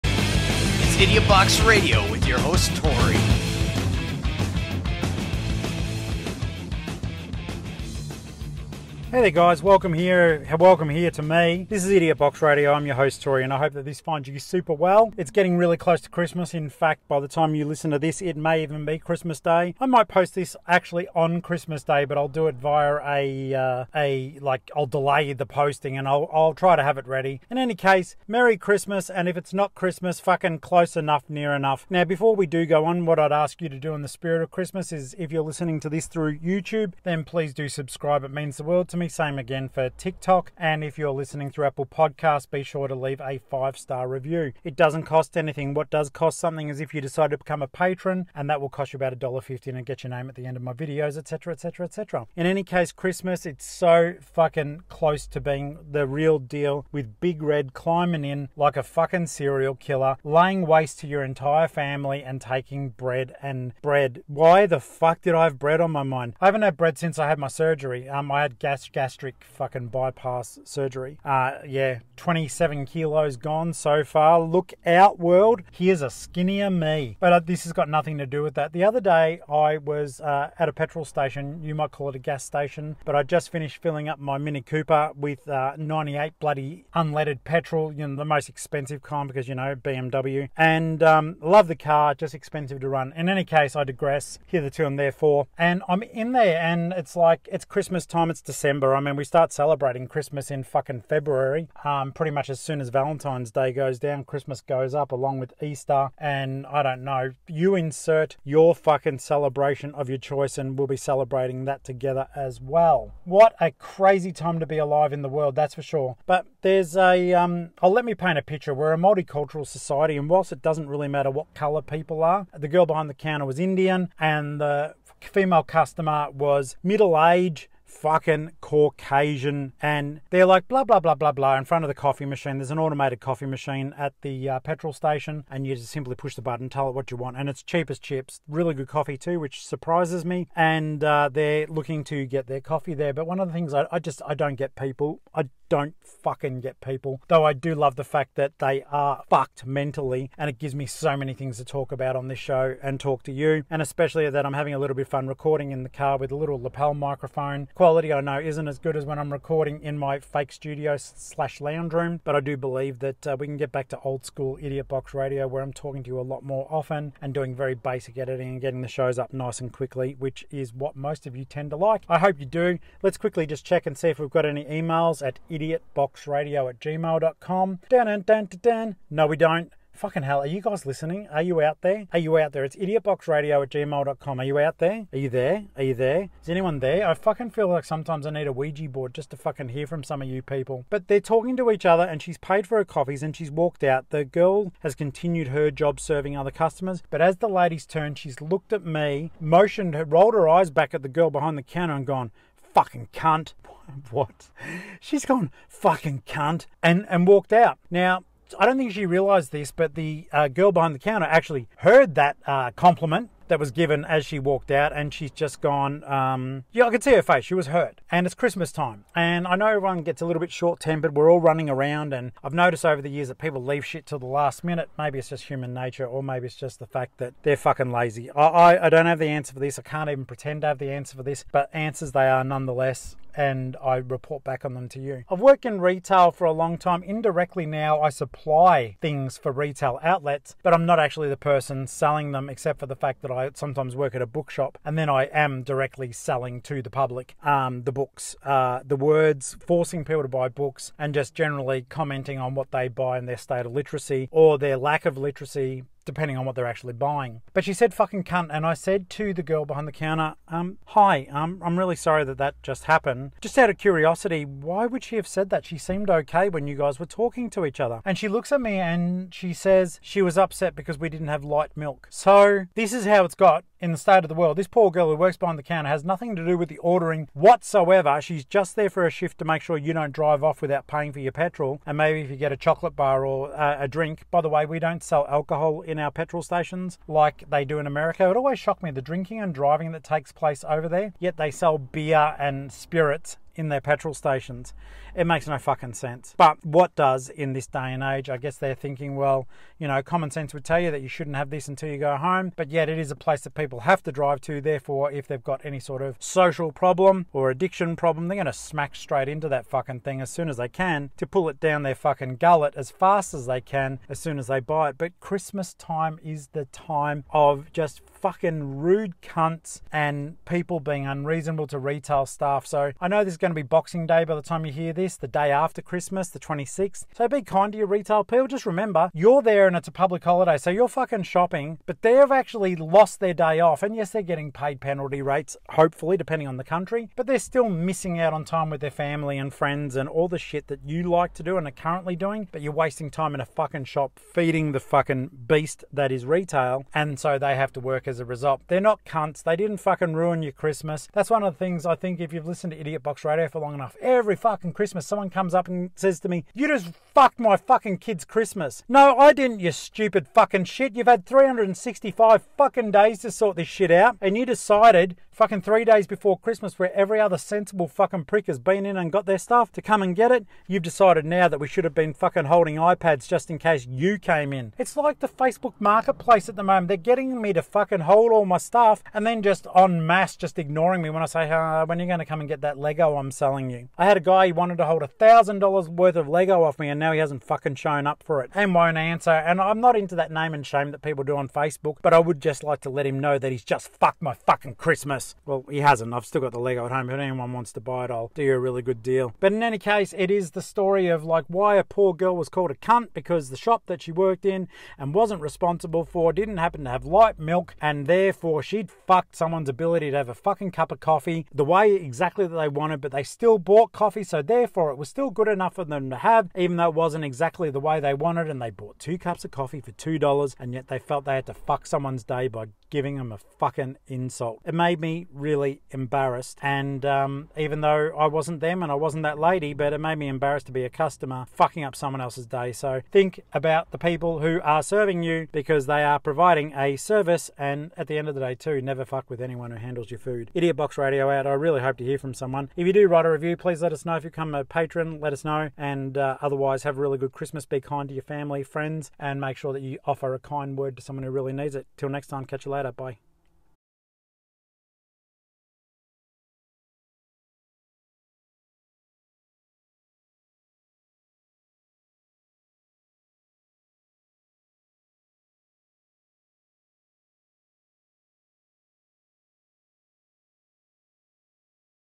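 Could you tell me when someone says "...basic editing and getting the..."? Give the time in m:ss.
2:47.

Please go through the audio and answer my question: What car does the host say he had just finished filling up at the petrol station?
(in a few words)
Mini Cooper.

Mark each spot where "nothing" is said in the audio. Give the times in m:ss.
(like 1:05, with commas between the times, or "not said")
1:17, 4:36.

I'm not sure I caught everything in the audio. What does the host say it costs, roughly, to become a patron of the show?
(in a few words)
$1.50.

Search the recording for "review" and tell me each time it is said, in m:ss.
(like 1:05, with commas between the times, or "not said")
0:44, 7:23.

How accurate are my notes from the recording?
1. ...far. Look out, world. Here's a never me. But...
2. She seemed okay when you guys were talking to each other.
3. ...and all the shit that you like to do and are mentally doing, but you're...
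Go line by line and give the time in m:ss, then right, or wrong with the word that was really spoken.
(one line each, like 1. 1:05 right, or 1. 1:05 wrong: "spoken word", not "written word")
1. 1:14 wrong: "skinnier", not "never"
2. 4:25 right
3. 5:39 wrong: "currently", not "mentally".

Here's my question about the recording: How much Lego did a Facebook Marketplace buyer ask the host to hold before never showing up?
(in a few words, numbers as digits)
$1000.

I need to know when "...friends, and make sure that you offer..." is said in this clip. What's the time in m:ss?
7:28.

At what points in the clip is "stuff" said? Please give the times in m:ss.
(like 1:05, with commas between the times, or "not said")
6:09, 6:18.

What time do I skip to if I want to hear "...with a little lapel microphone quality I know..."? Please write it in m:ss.
2:36.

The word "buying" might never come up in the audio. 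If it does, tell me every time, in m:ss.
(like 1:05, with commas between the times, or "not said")
4:16.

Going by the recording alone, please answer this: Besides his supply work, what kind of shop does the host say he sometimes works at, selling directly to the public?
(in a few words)
Bookshop.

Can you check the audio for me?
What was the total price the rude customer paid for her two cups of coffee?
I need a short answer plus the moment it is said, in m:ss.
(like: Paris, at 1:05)
$2, at 6:59.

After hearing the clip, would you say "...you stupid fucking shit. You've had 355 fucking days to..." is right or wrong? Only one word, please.
wrong.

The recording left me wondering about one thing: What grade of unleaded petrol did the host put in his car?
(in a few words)
98.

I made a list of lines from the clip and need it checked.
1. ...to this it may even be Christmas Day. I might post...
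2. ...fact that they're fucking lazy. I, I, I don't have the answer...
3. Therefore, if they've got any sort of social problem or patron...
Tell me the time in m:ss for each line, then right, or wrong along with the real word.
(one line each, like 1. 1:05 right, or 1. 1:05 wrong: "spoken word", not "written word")
1. 0:17 right
2. 3:46 right
3. 5:04 wrong: "addiction", not "patron".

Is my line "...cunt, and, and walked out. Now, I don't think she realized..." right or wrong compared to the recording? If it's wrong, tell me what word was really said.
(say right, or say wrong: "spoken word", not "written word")
right.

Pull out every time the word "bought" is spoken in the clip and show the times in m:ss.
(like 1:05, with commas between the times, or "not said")
6:53, 6:58.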